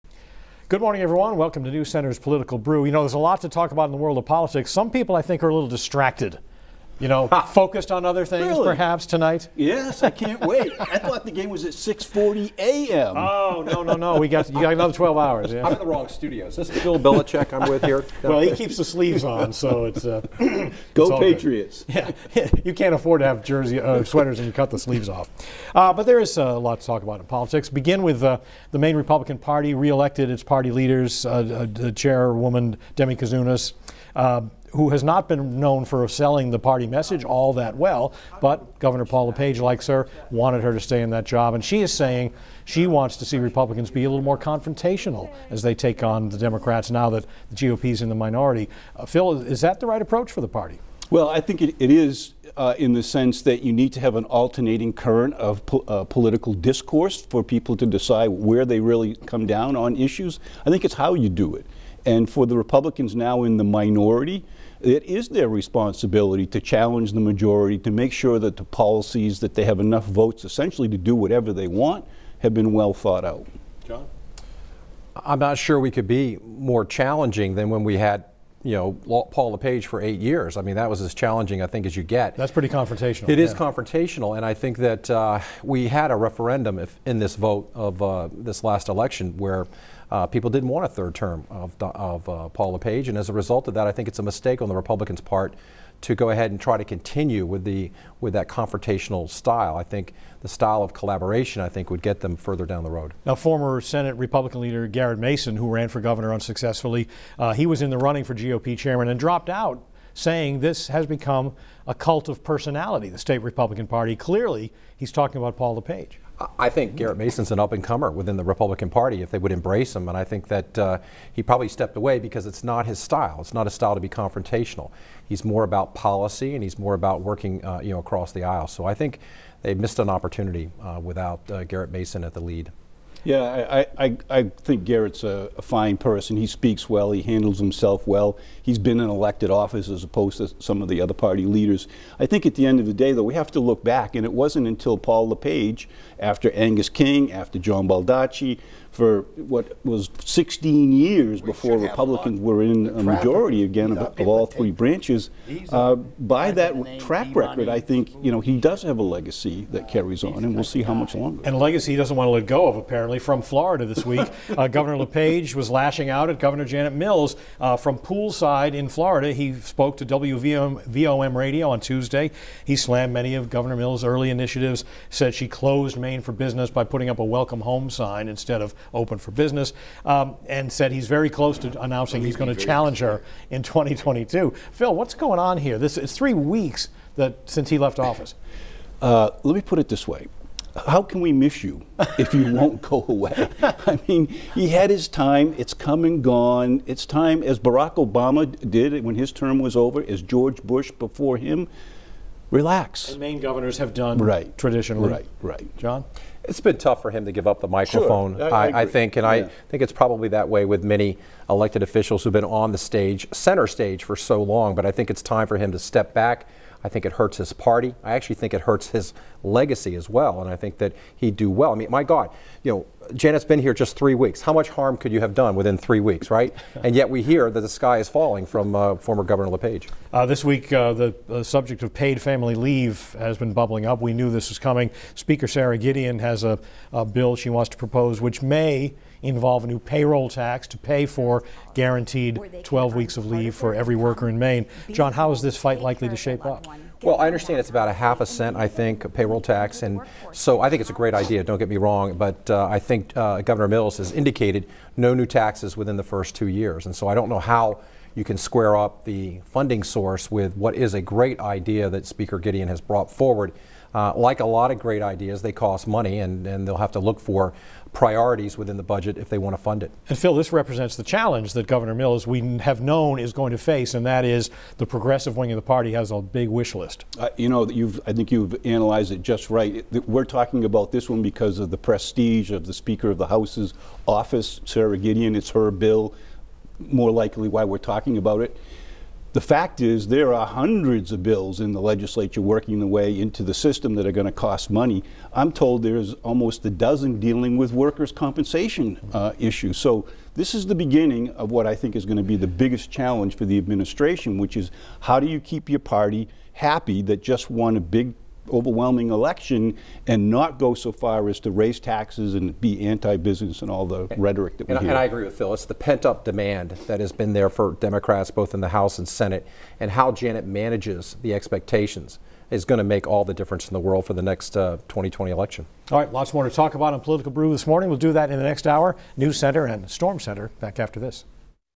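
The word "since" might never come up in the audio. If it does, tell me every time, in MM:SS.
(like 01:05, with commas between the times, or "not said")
03:07.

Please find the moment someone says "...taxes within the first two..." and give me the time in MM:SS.
04:15.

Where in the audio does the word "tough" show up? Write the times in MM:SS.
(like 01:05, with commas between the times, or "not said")
03:26.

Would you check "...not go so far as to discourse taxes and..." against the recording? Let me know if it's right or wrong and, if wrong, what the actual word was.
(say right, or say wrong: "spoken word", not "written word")
wrong: "raise", not "discourse".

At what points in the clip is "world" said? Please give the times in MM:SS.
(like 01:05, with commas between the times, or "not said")
00:03, 05:23.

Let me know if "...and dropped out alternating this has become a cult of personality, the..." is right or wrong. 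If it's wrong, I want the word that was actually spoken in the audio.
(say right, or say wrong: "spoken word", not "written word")
wrong: "saying", not "alternating".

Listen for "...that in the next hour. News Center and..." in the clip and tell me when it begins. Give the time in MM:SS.
05:28.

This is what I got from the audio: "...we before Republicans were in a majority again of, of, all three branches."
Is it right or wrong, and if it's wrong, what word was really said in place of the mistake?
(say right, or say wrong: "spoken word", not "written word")
right.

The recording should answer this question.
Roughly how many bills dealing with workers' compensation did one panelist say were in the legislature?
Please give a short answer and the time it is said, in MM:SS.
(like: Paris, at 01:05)
almost a dozen, at 04:56.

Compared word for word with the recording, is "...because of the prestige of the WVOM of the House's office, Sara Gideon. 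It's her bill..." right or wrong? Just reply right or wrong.
wrong.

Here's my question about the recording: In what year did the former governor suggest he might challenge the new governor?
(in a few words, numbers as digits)
2022.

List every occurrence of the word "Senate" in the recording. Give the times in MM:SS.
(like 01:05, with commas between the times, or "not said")
01:43, 05:19.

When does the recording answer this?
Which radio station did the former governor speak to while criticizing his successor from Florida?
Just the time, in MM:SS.
02:50.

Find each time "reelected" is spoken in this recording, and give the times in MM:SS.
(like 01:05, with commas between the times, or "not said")
00:29.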